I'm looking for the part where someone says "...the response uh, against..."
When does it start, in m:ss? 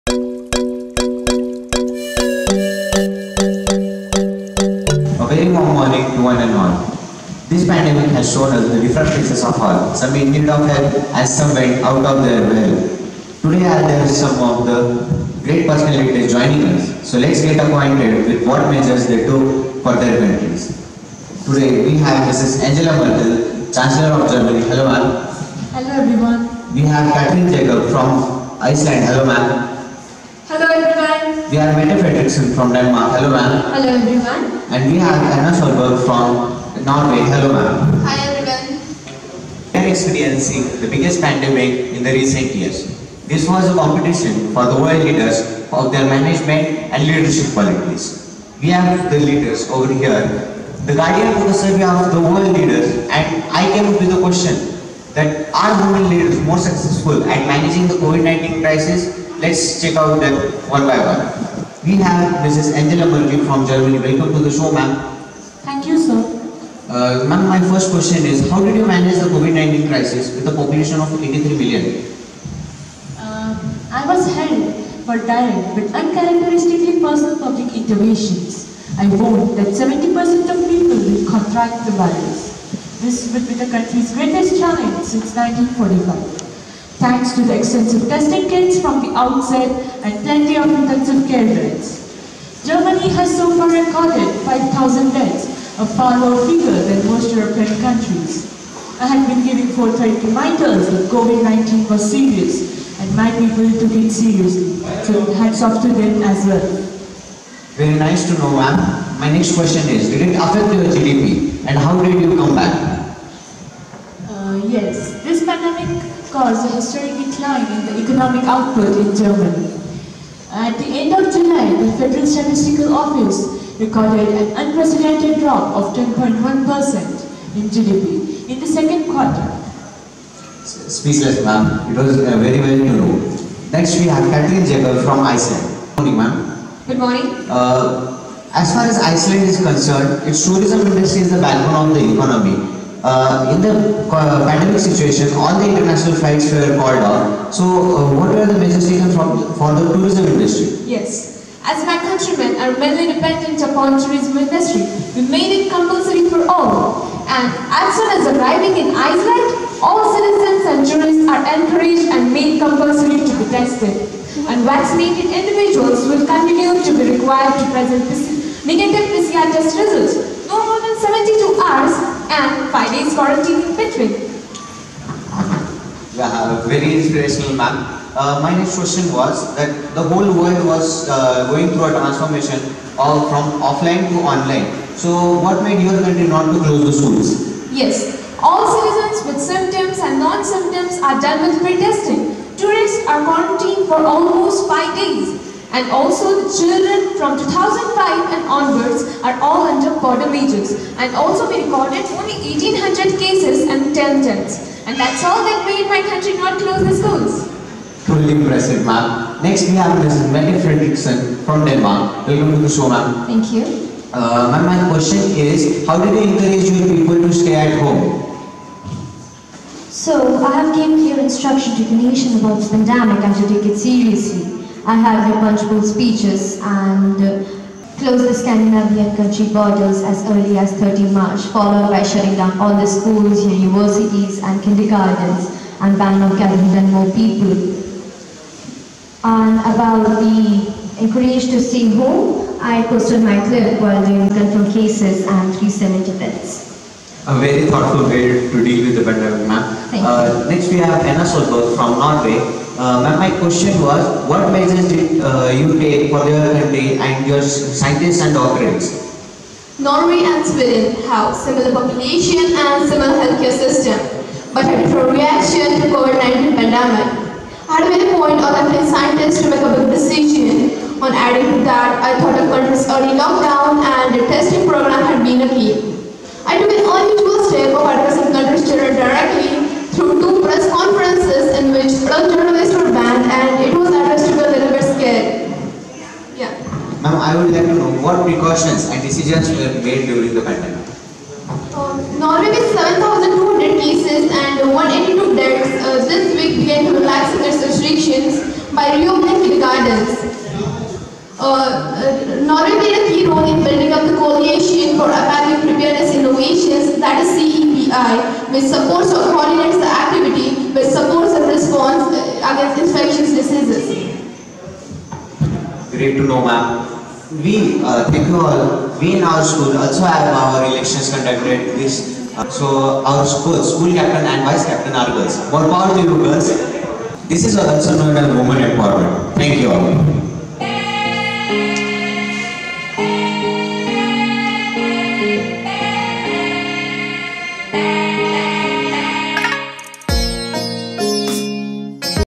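5:11.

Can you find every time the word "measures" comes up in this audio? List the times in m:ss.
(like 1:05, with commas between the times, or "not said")
0:18, 4:14.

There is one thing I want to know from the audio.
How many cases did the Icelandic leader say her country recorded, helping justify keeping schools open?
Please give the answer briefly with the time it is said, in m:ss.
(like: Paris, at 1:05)
1800, at 3:22.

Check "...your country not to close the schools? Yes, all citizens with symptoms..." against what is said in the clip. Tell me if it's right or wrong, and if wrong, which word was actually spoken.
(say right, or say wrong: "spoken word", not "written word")
right.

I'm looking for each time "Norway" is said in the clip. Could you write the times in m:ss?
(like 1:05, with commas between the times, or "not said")
0:36, 4:11, 4:19, 4:52, 5:02.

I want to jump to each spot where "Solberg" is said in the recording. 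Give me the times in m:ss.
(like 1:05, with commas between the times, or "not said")
0:35, 4:11.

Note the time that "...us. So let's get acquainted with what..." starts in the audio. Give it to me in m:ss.
0:16.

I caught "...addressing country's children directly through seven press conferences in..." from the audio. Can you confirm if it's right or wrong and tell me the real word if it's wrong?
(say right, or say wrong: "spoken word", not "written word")
wrong: "two", not "seven".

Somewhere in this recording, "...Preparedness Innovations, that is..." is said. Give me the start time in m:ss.
5:05.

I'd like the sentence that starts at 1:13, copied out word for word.
Uh, I was held for direct but uncharacteristically personal public interventions.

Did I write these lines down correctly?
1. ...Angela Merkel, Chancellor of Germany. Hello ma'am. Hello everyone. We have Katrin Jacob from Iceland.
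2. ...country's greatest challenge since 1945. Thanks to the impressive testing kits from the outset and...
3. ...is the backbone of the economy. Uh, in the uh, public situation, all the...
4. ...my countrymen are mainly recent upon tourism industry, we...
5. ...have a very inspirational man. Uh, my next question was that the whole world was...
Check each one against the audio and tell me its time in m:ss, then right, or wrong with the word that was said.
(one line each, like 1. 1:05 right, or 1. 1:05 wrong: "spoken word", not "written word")
1. 0:22 right
2. 1:23 wrong: "extensive", not "impressive"
3. 2:21 wrong: "pandemic", not "public"
4. 2:31 wrong: "dependent", not "recent"
5. 2:56 right.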